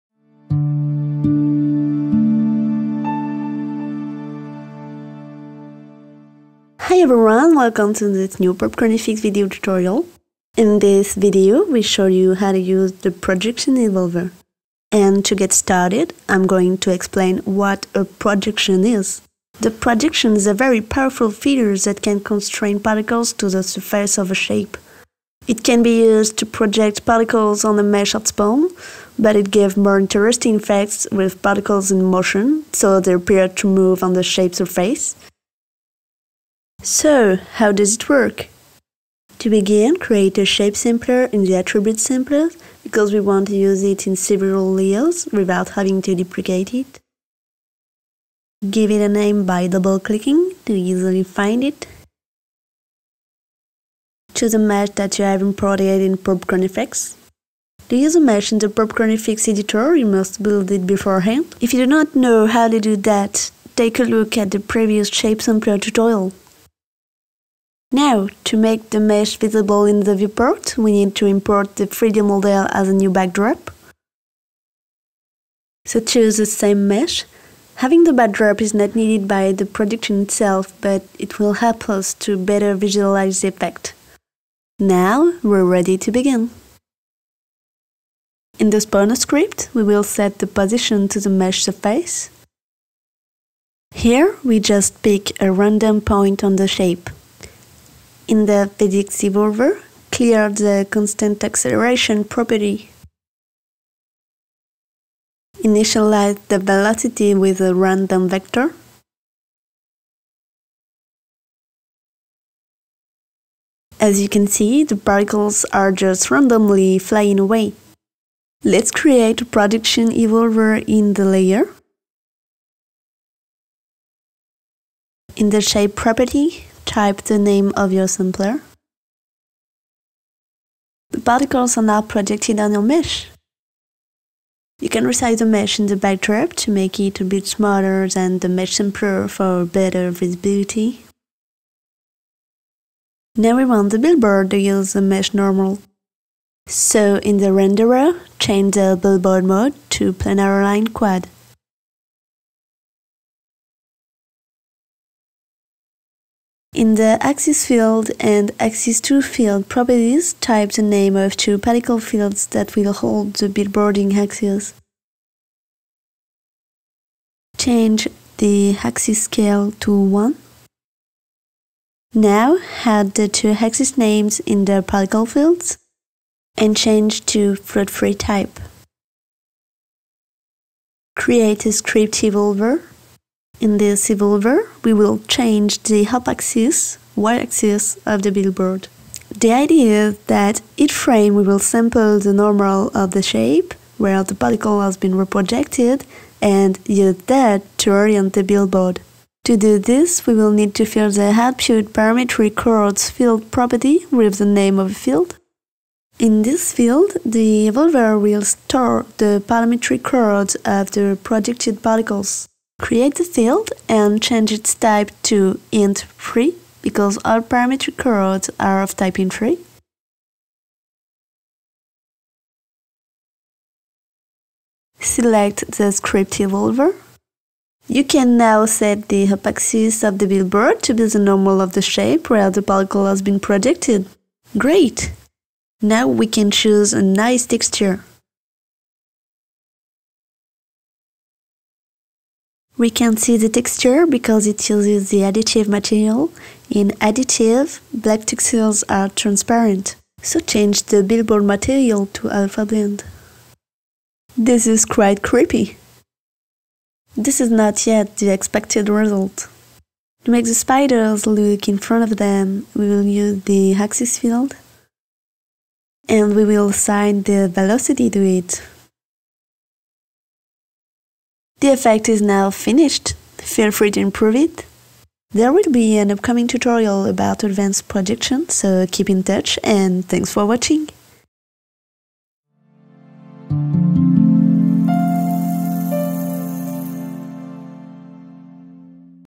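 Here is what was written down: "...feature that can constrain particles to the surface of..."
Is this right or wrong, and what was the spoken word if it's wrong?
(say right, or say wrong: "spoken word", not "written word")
right.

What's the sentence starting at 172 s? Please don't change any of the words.
Now add the two axis names in the particle fields and change to float3 type.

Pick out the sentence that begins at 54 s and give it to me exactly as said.
Choose a mesh that you have imported in PopcornFX.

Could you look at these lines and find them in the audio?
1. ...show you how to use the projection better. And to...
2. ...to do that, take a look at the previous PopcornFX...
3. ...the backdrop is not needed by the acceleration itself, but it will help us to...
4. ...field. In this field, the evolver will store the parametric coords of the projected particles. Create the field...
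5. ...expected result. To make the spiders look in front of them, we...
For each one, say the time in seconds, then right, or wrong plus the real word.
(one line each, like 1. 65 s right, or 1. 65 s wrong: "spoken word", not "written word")
1. 11 s wrong: "evolver", not "better"
2. 62 s wrong: "Shape", not "PopcornFX"
3. 78 s wrong: "projection", not "acceleration"
4. 204 s right
5. 258 s right.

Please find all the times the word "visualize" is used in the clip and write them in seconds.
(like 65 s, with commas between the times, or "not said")
82 s.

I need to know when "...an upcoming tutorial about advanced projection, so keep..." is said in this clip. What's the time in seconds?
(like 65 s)
275 s.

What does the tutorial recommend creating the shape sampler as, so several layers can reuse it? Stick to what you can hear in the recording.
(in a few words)
Attribute sampler.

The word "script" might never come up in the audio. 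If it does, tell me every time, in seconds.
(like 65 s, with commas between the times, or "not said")
89 s, 181 s, 225 s.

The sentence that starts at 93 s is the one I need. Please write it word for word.
Here, we just pick a random point on the shape in the physics evolver, clear the constant acceleration property.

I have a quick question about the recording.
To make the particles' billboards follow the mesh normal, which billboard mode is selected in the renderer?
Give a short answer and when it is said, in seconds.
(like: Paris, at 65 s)
Planar aligned quad, at 150 s.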